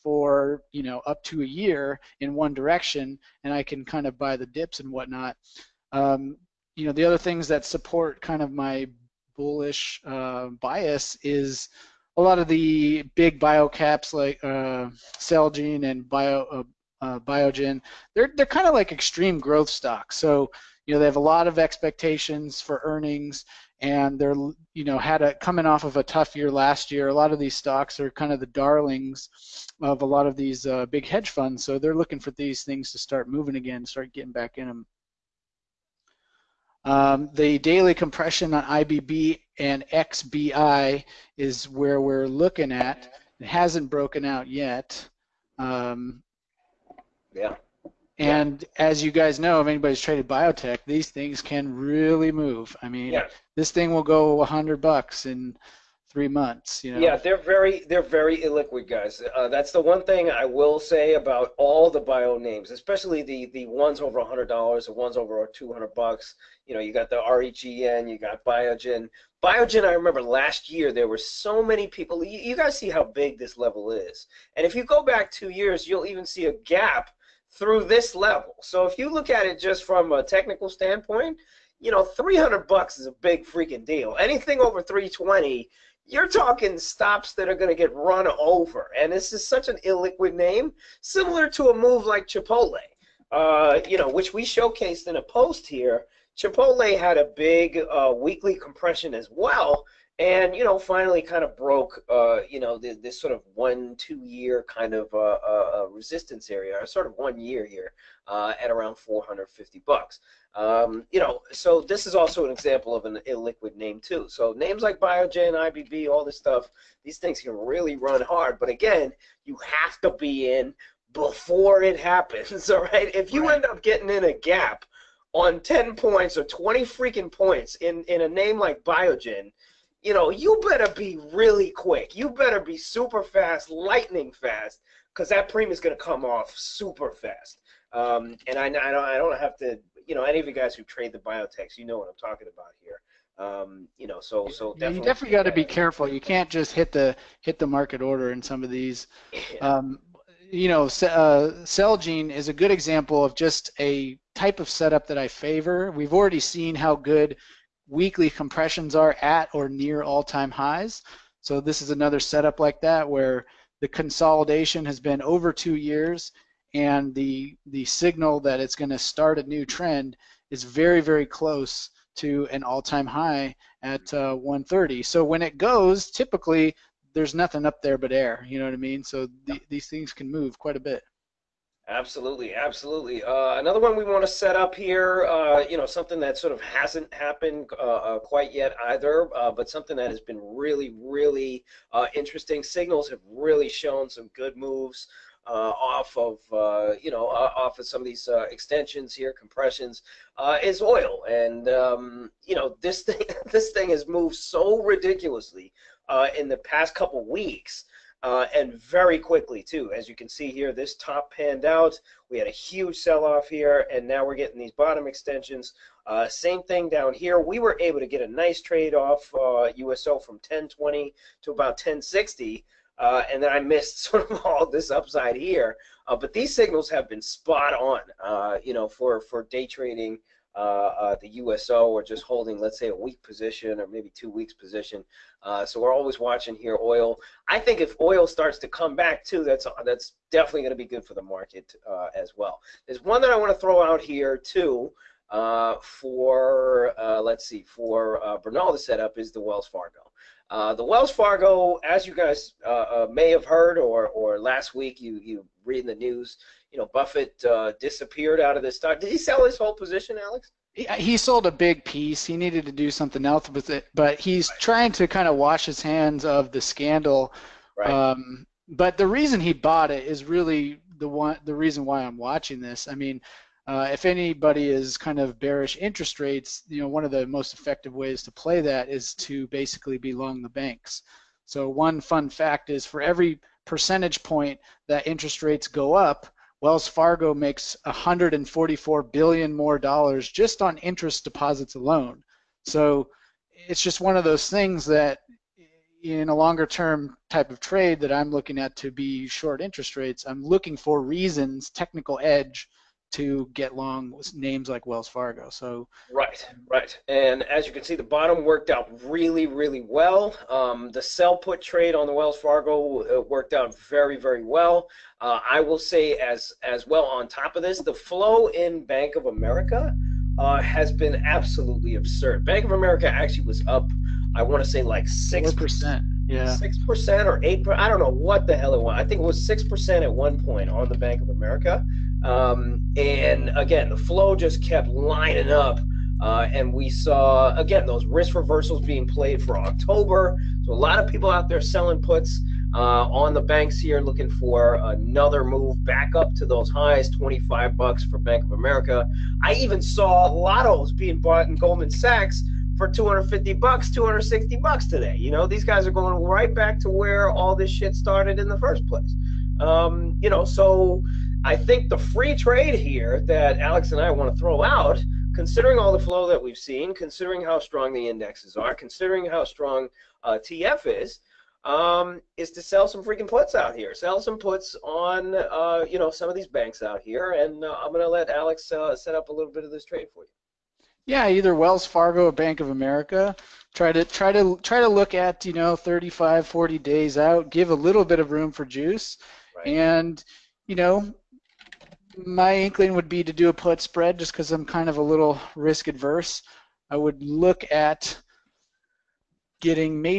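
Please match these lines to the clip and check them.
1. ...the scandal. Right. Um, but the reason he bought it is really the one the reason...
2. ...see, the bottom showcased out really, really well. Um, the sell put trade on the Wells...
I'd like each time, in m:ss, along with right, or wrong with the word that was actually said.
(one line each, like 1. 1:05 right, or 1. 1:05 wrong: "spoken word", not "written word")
1. 4:26 right
2. 5:07 wrong: "worked", not "showcased".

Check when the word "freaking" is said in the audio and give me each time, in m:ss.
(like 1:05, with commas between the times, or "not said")
1:23, 2:06, 6:13.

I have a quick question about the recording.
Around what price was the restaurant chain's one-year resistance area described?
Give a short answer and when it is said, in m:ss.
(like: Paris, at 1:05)
450 bucks, at 1:48.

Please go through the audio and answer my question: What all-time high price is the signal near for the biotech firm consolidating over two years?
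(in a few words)
130.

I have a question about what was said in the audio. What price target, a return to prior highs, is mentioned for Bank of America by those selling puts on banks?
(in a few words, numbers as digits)
25 bucks.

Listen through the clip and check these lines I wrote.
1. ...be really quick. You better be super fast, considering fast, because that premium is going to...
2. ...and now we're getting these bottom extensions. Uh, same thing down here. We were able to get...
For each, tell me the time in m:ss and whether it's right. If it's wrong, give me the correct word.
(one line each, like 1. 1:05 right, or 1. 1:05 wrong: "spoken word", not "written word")
1. 2:10 wrong: "lightning", not "considering"
2. 3:33 right.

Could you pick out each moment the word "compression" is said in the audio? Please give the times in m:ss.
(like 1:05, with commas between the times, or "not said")
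0:37, 1:38, 2:38, 3:19.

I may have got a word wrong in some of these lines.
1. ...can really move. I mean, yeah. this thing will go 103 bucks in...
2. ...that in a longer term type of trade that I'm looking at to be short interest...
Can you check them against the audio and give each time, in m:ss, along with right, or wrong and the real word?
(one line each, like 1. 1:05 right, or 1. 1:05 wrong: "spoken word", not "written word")
1. 0:51 wrong: "100", not "103"
2. 4:54 right.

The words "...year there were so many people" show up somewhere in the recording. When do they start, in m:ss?
1:10.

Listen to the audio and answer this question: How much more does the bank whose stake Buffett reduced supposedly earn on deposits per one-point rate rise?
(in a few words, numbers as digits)
144 billion.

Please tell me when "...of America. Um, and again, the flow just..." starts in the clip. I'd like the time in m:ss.
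5:31.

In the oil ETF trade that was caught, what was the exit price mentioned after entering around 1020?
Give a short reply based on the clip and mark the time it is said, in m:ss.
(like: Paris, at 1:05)
1060, at 3:41.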